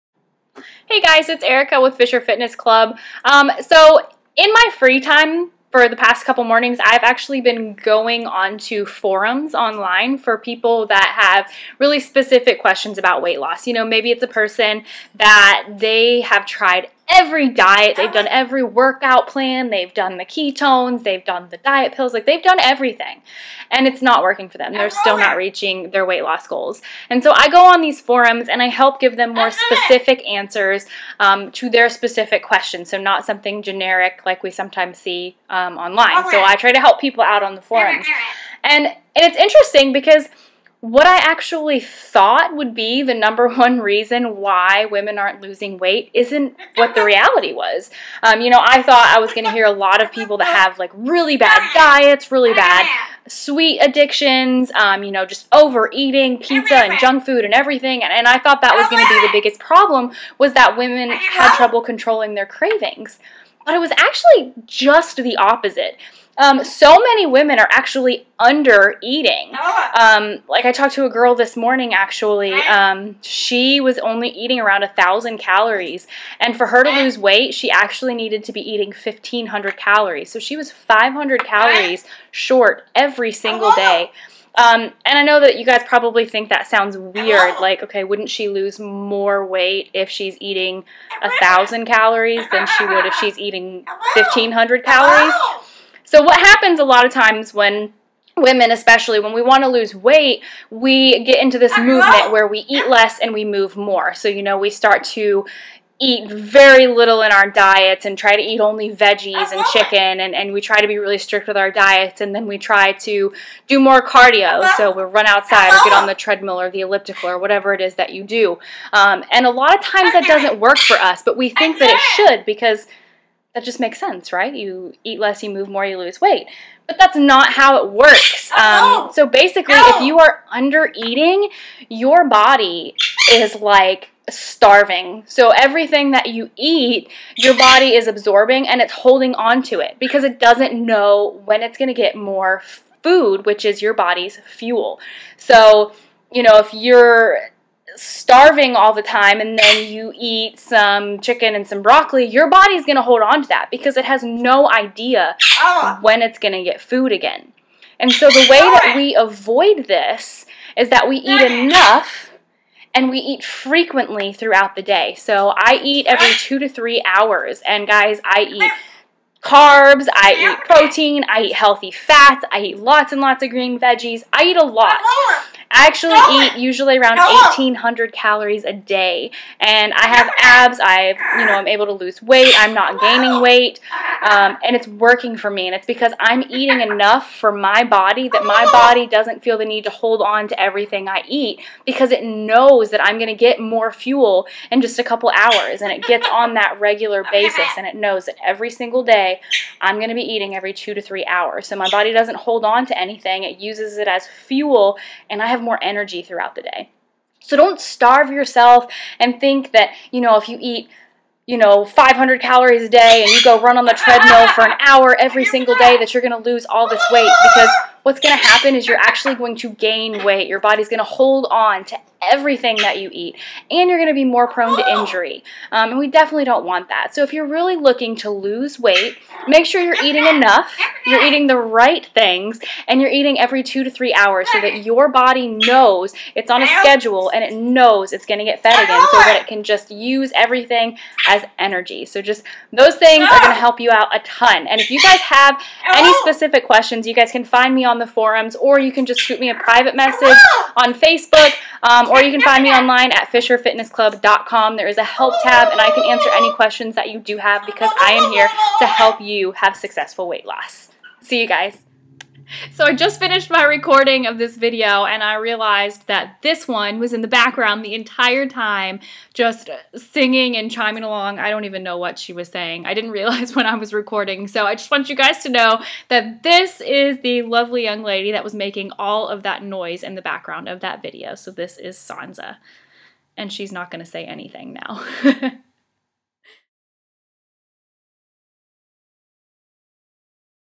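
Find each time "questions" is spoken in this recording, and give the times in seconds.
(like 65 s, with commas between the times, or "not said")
12 s, 32 s, 246 s, 256 s.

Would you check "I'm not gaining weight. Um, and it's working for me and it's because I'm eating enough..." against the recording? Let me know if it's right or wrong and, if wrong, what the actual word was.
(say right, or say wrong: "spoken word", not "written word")
right.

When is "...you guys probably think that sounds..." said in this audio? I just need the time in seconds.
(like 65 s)
85 s.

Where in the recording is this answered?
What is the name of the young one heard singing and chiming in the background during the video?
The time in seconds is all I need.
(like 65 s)
281 s.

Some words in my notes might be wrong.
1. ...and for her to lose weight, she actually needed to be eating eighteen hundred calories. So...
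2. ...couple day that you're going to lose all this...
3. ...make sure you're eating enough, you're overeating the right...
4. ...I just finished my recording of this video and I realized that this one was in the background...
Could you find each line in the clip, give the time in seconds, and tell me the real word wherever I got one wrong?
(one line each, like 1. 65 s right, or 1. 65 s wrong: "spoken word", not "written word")
1. 76 s wrong: "fifteen", not "eighteen"
2. 215 s wrong: "single", not "couple"
3. 229 s wrong: "eating", not "overeating"
4. 262 s right.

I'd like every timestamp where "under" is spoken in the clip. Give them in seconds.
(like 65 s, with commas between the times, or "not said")
68 s, 130 s.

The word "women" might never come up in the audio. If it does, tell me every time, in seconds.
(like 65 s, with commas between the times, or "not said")
44 s, 60 s, 67 s, 98 s.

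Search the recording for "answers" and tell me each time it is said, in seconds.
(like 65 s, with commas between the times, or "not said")
30 s, 256 s.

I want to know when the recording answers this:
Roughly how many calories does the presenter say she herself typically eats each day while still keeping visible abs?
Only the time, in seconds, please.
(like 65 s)
177 s.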